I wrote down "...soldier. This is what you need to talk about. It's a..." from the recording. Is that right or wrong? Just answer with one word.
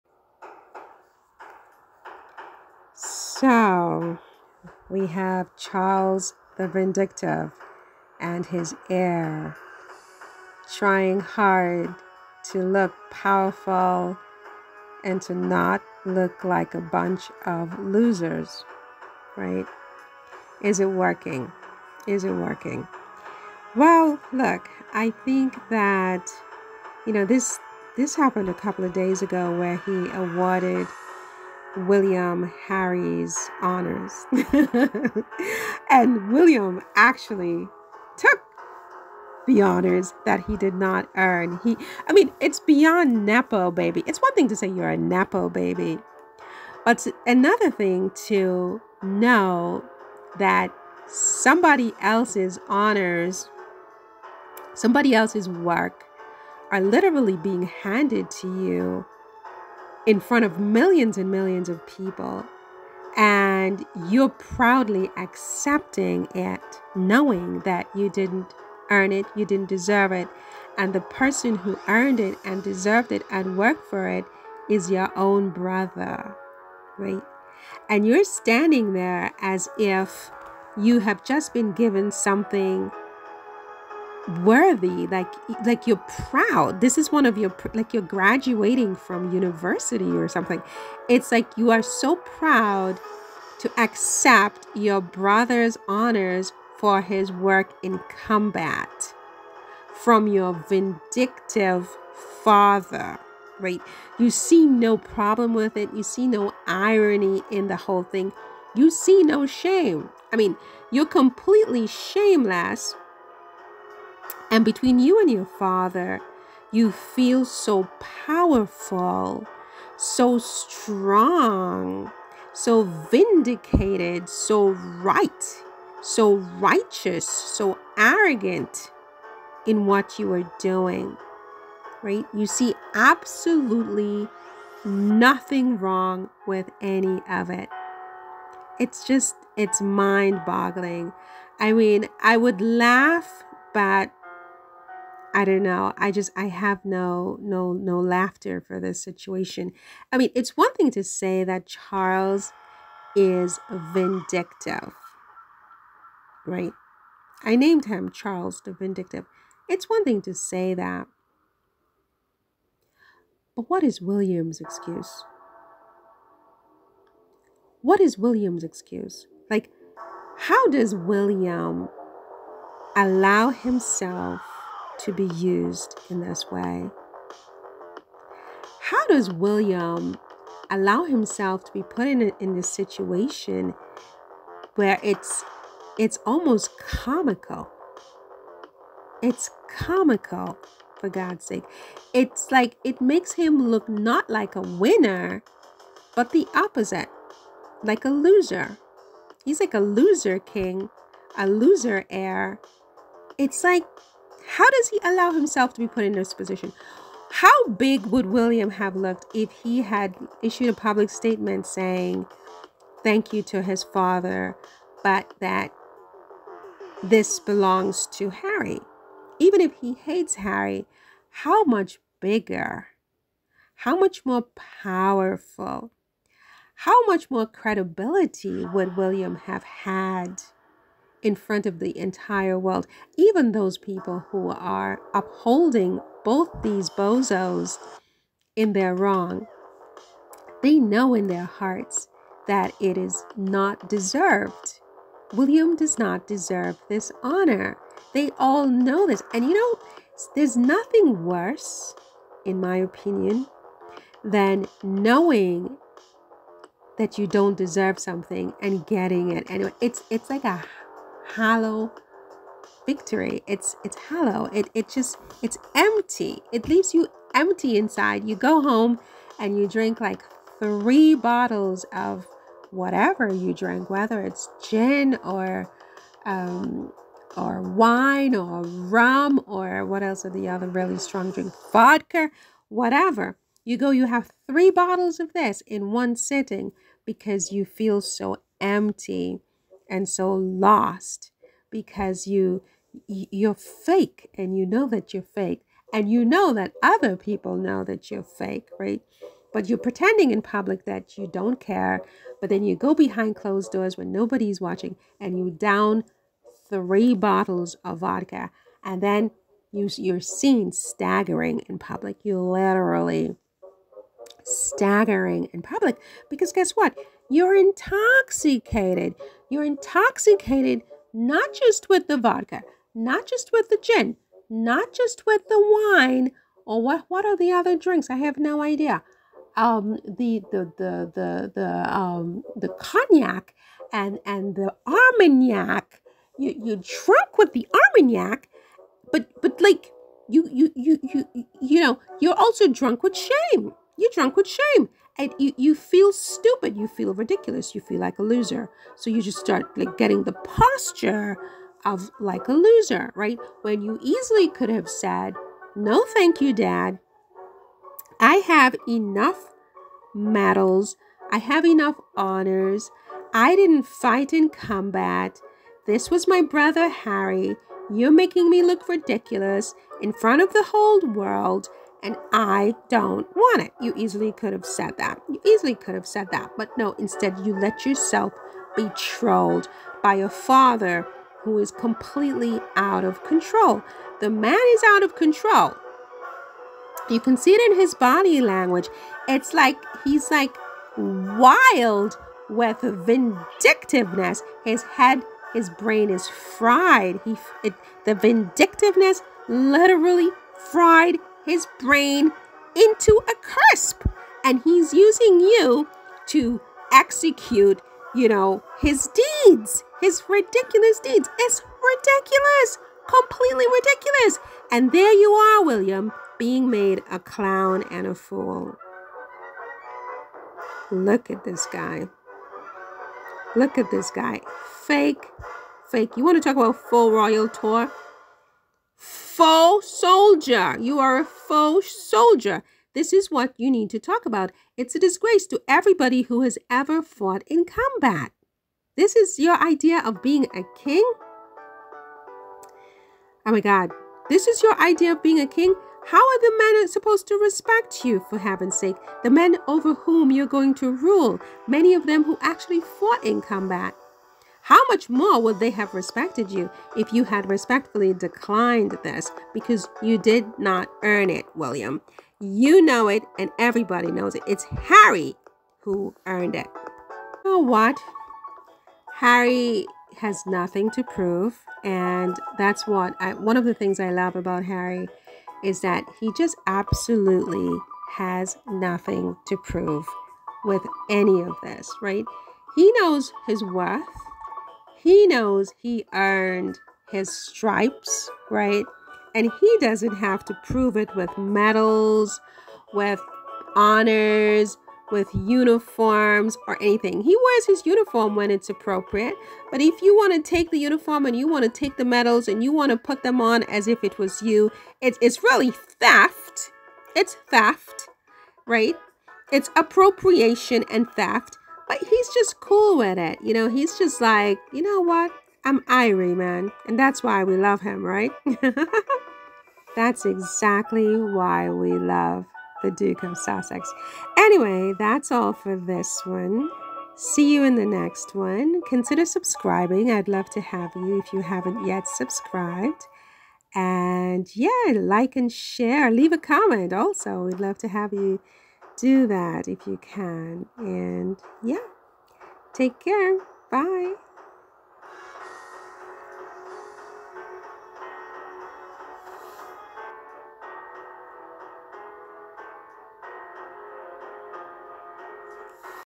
right.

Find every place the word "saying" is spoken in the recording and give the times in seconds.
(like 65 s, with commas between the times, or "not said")
211 s.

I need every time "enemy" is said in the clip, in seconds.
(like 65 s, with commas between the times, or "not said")
not said.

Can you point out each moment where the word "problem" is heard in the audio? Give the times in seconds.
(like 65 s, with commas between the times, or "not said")
104 s.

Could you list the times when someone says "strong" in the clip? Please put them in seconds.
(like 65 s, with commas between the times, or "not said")
120 s, 280 s.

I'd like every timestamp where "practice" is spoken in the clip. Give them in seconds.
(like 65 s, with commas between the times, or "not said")
not said.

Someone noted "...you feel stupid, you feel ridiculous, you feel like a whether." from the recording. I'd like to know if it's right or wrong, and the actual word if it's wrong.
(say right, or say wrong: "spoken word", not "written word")
wrong: "loser", not "whether".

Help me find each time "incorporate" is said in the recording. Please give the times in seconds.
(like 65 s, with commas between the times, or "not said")
not said.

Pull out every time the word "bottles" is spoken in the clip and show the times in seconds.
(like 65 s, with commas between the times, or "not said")
271 s, 284 s, 307 s.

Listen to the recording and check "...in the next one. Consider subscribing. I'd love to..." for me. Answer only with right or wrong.
right.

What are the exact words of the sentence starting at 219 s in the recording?
Even if he hates Harry, how much bigger, how much more powerful, how much more credibility would William have had?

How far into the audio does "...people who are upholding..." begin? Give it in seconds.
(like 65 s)
233 s.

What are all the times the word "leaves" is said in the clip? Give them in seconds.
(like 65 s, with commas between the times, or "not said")
266 s, 536 s.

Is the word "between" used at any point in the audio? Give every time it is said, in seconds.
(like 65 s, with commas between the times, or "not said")
114 s.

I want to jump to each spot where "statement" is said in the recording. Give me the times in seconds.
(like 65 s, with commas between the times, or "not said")
211 s.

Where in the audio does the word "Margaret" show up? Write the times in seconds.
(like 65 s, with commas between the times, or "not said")
not said.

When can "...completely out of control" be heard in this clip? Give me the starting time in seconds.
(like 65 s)
381 s.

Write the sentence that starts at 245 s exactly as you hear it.
William does not deserve this honor.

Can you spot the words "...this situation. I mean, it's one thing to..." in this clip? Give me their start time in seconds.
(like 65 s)
148 s.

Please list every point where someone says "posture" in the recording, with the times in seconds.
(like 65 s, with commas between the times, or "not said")
350 s.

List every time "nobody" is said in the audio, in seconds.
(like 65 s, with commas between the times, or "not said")
304 s.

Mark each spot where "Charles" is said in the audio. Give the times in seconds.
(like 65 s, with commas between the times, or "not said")
5 s, 151 s, 158 s.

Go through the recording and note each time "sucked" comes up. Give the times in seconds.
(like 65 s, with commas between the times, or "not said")
not said.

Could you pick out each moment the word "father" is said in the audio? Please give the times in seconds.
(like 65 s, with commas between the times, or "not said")
102 s, 115 s, 213 s, 380 s.